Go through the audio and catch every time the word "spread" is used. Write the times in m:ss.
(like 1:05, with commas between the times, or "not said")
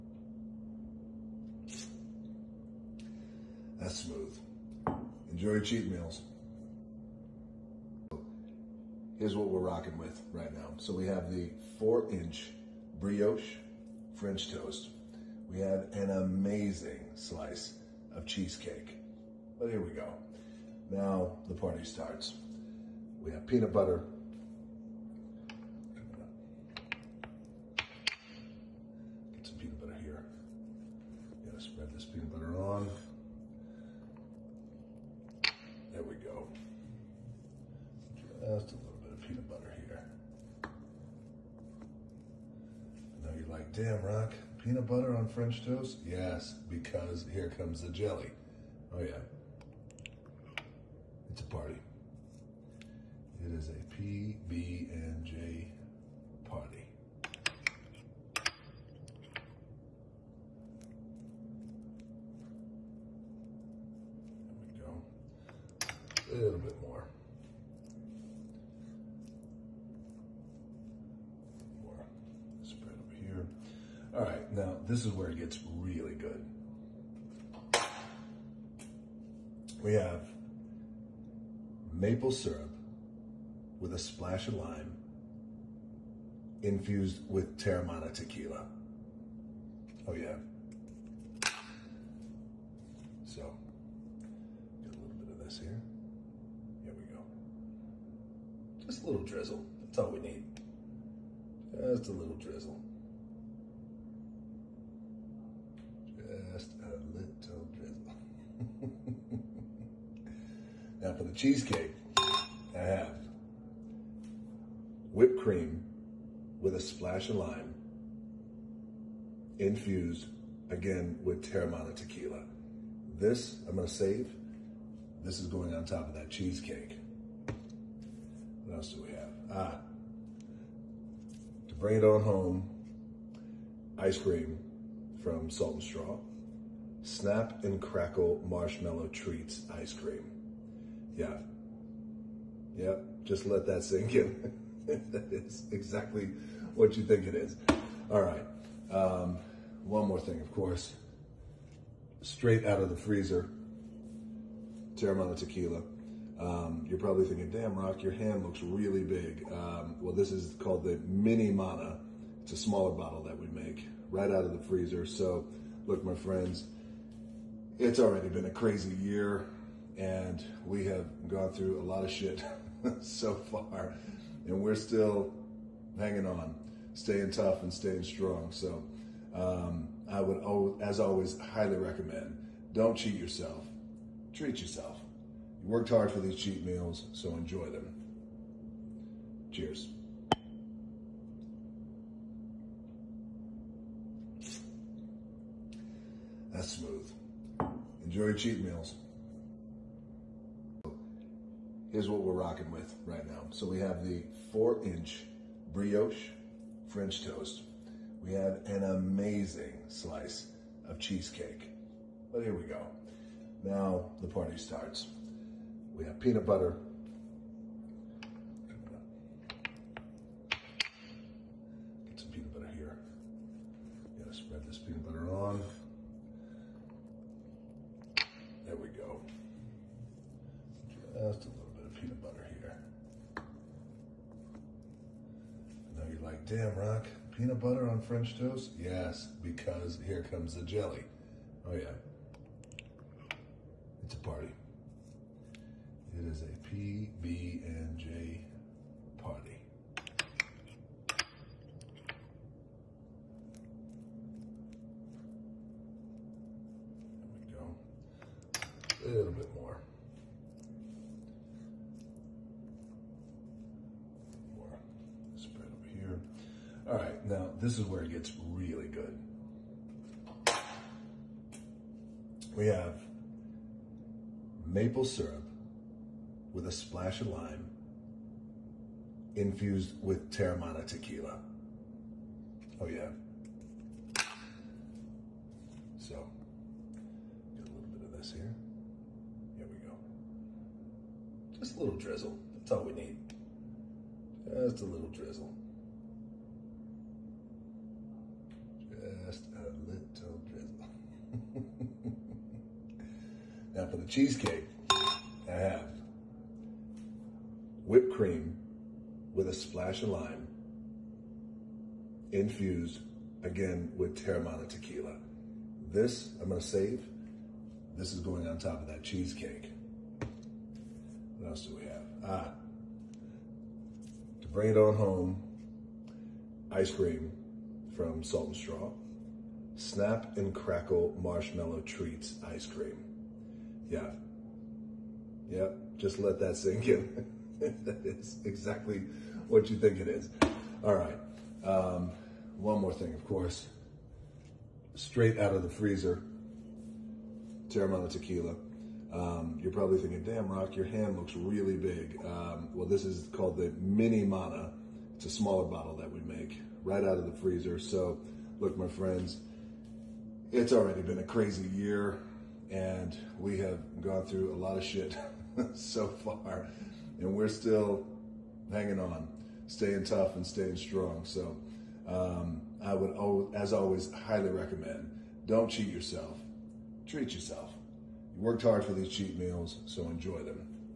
3:44.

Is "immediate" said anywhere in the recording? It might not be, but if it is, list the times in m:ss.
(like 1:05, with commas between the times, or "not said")
not said.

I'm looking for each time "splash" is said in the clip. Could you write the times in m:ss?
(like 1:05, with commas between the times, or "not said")
1:23, 1:56, 4:36, 5:09.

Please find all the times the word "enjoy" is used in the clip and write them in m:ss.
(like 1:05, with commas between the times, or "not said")
0:05, 3:07, 3:18, 6:20.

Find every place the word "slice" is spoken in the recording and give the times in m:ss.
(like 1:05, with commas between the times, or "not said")
0:17, 3:29.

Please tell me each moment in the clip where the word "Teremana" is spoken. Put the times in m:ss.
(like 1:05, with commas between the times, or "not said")
1:27, 2:01, 2:34, 4:40, 5:14, 5:47.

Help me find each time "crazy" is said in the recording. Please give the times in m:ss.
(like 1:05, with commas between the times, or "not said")
2:48, 6:01.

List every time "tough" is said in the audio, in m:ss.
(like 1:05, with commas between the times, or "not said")
2:57, 6:10.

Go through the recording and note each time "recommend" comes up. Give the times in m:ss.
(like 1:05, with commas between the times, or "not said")
3:01, 6:14.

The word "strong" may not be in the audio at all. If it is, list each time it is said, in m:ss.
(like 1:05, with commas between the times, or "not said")
2:58, 6:10.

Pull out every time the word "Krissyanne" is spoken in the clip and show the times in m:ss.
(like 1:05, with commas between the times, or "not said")
not said.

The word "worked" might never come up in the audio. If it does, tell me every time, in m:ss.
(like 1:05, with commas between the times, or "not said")
3:05, 6:18.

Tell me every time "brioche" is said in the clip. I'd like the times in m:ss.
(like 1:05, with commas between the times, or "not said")
0:13, 3:25.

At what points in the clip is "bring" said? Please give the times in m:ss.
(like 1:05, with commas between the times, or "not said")
2:11, 5:24.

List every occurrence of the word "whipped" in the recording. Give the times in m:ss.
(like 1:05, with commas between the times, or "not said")
1:55, 5:07.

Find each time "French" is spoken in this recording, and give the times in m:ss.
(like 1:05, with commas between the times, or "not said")
0:14, 0:45, 3:26, 3:58.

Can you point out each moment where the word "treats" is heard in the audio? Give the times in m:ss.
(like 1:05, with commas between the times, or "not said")
2:19, 3:04, 5:31, 6:17.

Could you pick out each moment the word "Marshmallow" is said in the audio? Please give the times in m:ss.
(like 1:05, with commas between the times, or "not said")
2:18, 5:31.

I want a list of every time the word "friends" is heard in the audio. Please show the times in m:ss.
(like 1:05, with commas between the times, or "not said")
2:46, 5:58.